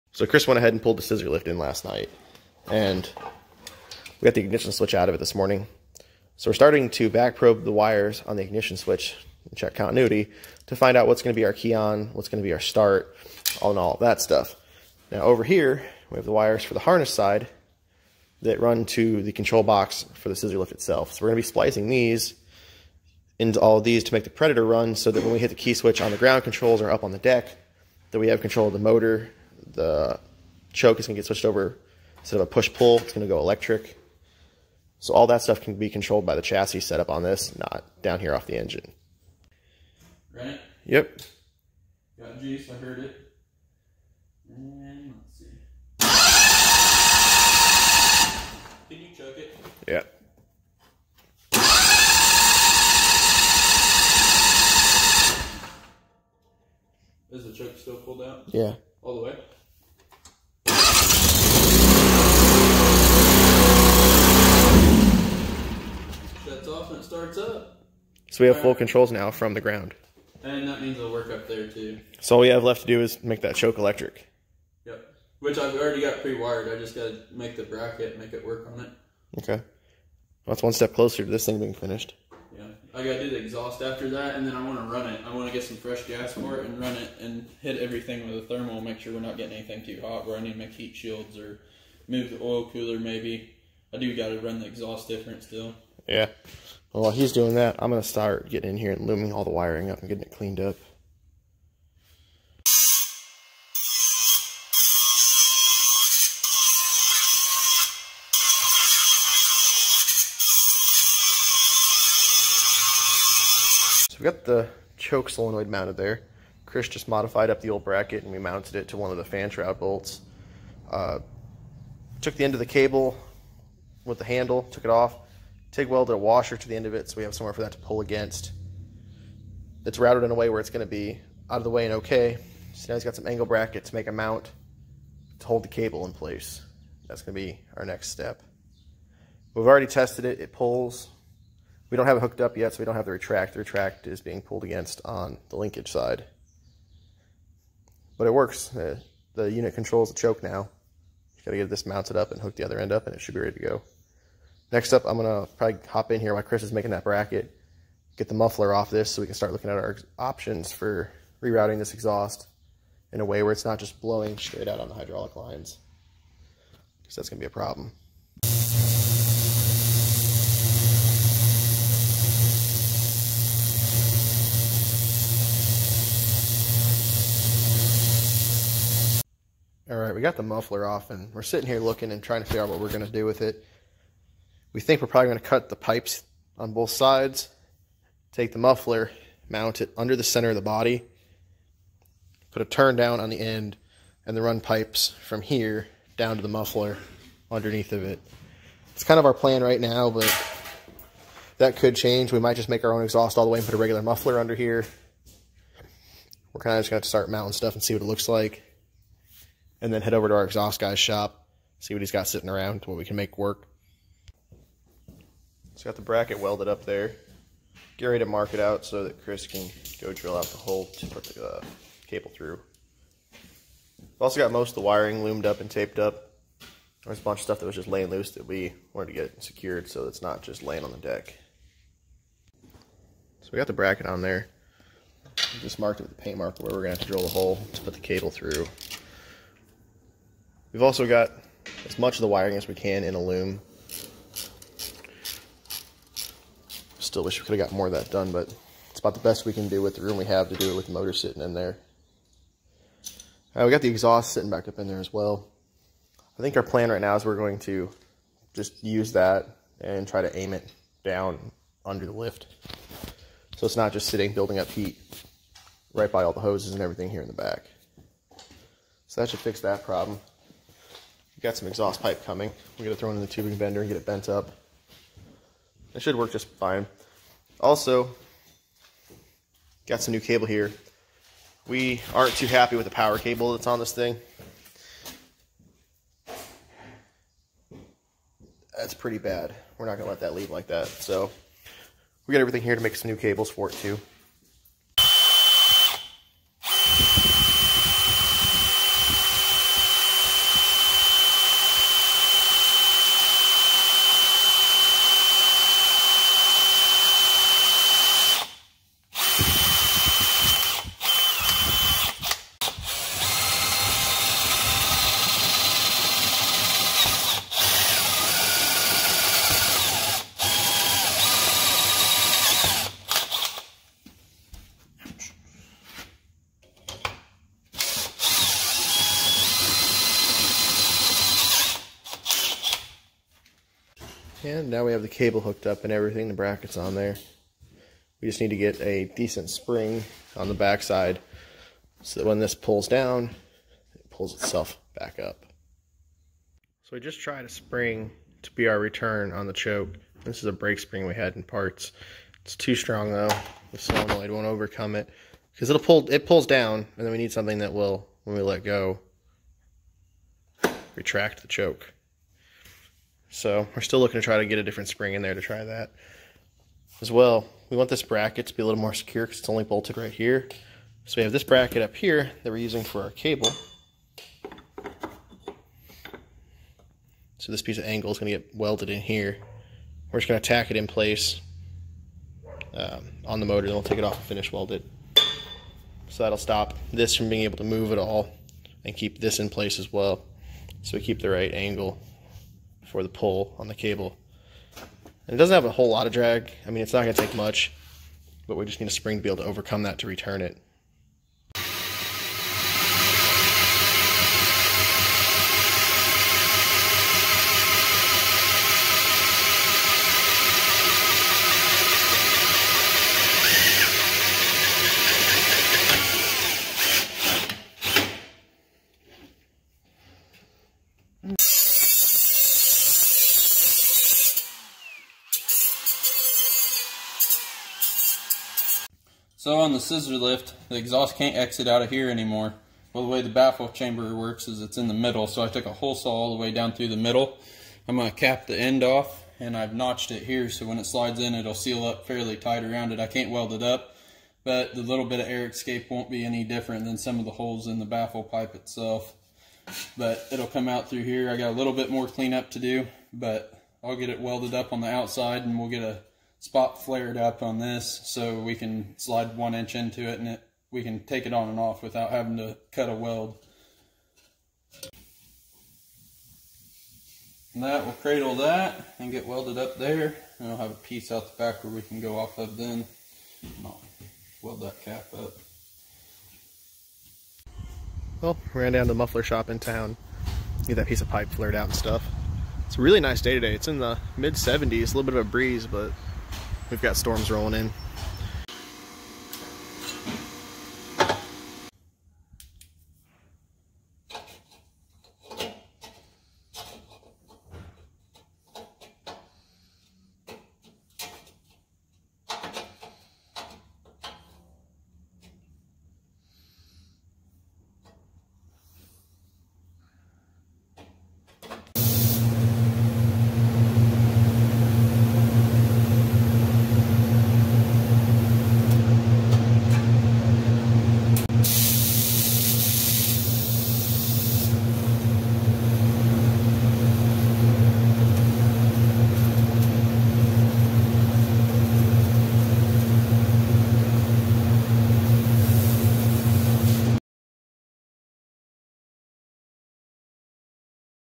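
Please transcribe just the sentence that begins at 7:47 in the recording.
And that will cradle that and get welded up there.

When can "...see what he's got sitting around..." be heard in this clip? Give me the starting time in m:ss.
3:31.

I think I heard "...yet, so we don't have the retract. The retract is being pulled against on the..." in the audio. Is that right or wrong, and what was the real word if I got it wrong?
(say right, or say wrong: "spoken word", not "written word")
right.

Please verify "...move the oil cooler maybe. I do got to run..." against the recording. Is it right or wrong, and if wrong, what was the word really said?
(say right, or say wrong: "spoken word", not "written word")
right.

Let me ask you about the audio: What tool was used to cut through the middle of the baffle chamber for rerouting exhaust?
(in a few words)
hole saw.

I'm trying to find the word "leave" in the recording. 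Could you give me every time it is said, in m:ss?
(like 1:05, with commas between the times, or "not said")
4:50.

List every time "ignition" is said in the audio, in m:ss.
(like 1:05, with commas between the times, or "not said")
0:04, 0:08.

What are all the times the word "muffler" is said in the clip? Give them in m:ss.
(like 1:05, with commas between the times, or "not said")
2:38, 3:00, 3:08, 3:16, 3:24, 7:58.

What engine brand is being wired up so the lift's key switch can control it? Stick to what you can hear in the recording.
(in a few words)
Predator.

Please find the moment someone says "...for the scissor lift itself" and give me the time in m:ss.
0:20.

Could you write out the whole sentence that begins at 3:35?
It's got the bracket welded up there.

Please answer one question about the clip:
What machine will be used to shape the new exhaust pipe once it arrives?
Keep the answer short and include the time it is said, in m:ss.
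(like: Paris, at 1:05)
tubing bender, at 4:33.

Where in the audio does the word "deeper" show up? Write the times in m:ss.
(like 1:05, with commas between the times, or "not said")
not said.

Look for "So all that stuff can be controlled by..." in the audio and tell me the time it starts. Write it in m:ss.
0:34.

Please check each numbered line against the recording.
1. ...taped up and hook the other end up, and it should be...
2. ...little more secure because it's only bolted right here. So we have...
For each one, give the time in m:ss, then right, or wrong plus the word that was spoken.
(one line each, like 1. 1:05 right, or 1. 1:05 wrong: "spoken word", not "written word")
1. 2:31 wrong: "mounted", not "taped"
2. 6:08 right.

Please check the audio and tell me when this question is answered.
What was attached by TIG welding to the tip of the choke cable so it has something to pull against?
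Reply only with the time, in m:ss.
2:06.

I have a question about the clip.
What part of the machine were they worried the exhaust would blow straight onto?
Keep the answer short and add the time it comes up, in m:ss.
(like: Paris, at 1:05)
hydraulic lines, at 2:44.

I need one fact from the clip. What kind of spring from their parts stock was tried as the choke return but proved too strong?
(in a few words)
brake spring.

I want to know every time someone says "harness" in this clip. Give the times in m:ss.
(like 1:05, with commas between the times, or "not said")
0:16.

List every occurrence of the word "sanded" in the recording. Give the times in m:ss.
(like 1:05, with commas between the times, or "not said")
not said.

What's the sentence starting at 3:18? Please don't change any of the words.
It's kind of our plan right now, but that could change.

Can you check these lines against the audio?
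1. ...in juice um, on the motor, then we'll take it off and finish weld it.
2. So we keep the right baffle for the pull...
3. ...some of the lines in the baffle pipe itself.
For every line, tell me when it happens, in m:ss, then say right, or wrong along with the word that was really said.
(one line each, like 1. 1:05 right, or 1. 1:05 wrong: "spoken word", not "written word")
1. 6:20 wrong: "place", not "juice"
2. 6:30 wrong: "angle", not "baffle"
3. 7:26 wrong: "holes", not "lines".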